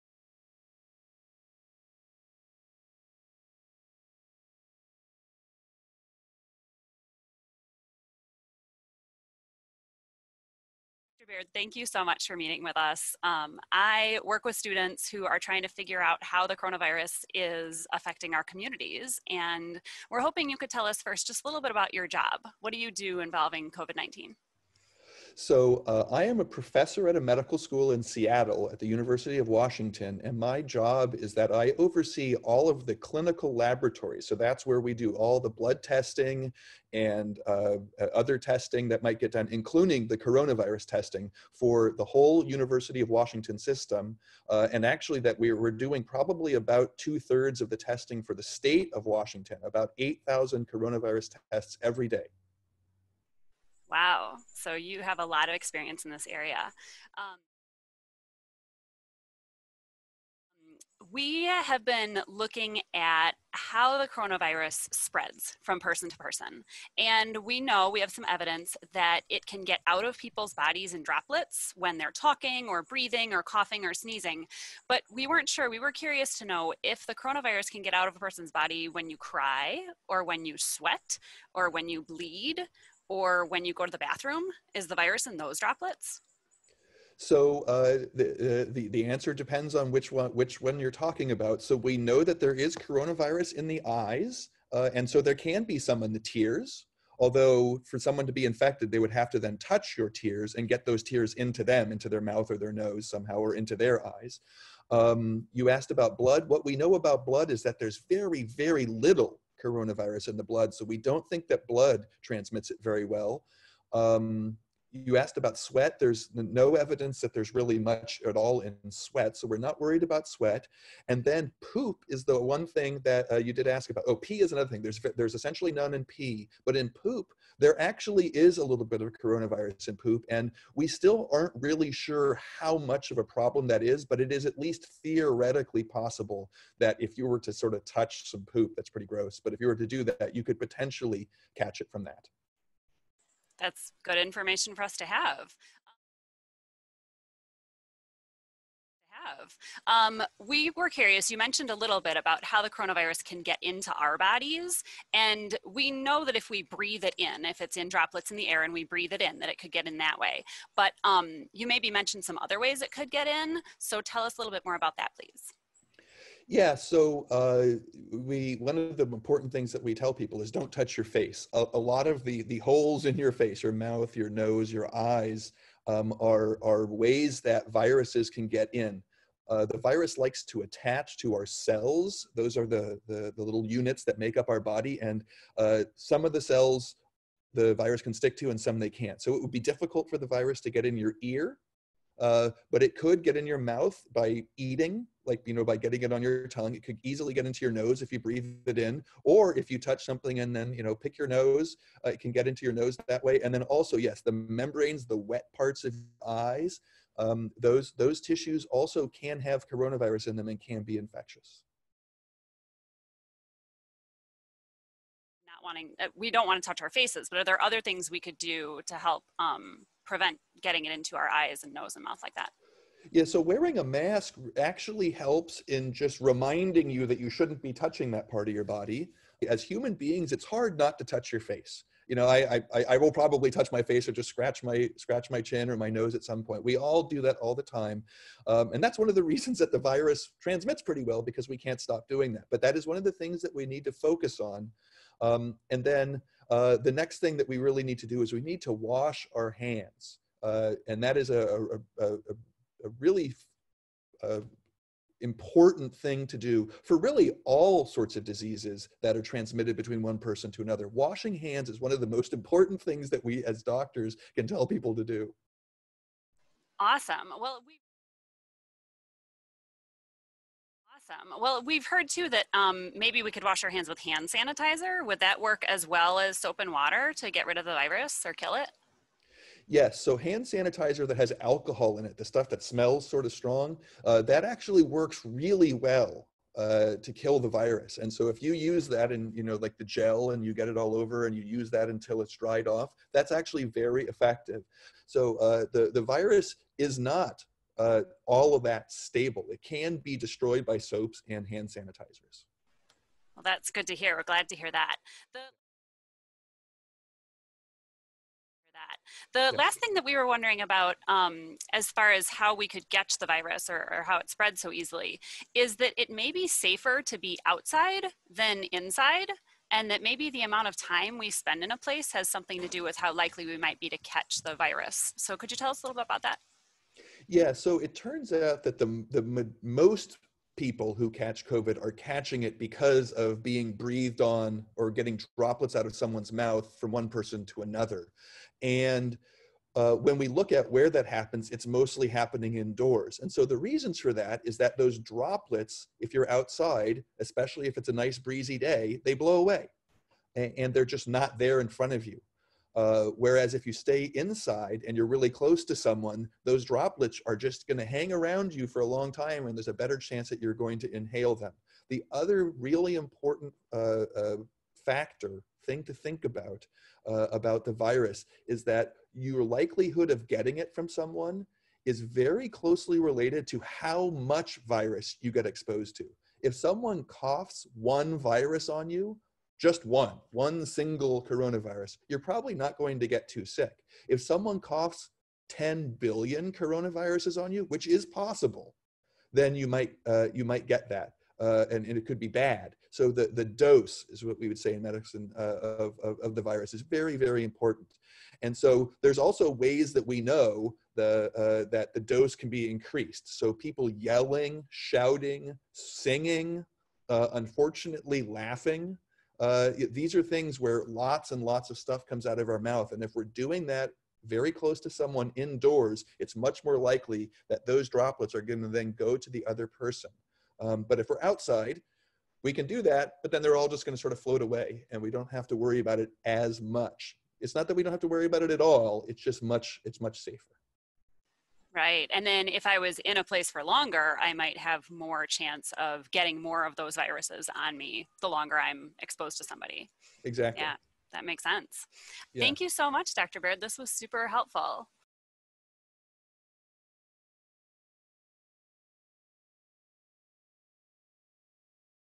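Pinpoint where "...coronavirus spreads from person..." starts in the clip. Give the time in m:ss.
1:04.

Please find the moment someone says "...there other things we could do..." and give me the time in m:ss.
3:37.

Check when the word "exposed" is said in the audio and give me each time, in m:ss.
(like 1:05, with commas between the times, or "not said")
6:15, 7:18.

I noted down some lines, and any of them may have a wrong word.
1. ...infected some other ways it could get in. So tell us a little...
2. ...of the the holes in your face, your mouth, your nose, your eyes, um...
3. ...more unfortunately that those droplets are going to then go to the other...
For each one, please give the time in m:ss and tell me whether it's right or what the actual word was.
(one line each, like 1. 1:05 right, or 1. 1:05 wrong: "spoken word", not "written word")
1. 2:41 wrong: "mentioned", not "infected"
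2. 2:52 right
3. 6:56 wrong: "likely", not "unfortunately".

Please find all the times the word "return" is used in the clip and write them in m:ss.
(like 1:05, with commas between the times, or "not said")
not said.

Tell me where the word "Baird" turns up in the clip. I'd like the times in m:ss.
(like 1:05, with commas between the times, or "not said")
0:11, 7:23.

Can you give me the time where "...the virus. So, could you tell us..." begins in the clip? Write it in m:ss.
5:24.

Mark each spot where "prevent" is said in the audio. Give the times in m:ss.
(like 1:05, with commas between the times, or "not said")
3:40.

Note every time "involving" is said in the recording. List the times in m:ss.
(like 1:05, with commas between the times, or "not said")
0:23.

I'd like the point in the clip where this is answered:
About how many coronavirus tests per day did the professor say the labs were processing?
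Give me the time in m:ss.
0:49.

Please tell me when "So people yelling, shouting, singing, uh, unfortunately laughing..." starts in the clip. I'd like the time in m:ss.
6:43.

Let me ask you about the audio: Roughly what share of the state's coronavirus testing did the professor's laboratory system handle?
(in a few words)
two thirds.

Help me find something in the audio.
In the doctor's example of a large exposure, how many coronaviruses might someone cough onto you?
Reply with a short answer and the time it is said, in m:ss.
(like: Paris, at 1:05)
10 billion, at 6:25.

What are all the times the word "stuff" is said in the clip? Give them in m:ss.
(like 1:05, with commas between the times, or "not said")
4:42, 6:51.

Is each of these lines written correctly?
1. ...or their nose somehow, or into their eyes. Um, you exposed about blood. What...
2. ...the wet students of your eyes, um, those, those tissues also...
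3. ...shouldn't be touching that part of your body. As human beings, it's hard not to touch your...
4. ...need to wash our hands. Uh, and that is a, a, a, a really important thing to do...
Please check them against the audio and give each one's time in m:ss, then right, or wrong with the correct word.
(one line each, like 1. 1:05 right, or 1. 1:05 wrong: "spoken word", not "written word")
1. 1:42 wrong: "asked", not "exposed"
2. 3:25 wrong: "parts", not "students"
3. 3:47 right
4. 4:08 right.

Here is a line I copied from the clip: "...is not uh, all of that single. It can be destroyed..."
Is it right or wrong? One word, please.
wrong.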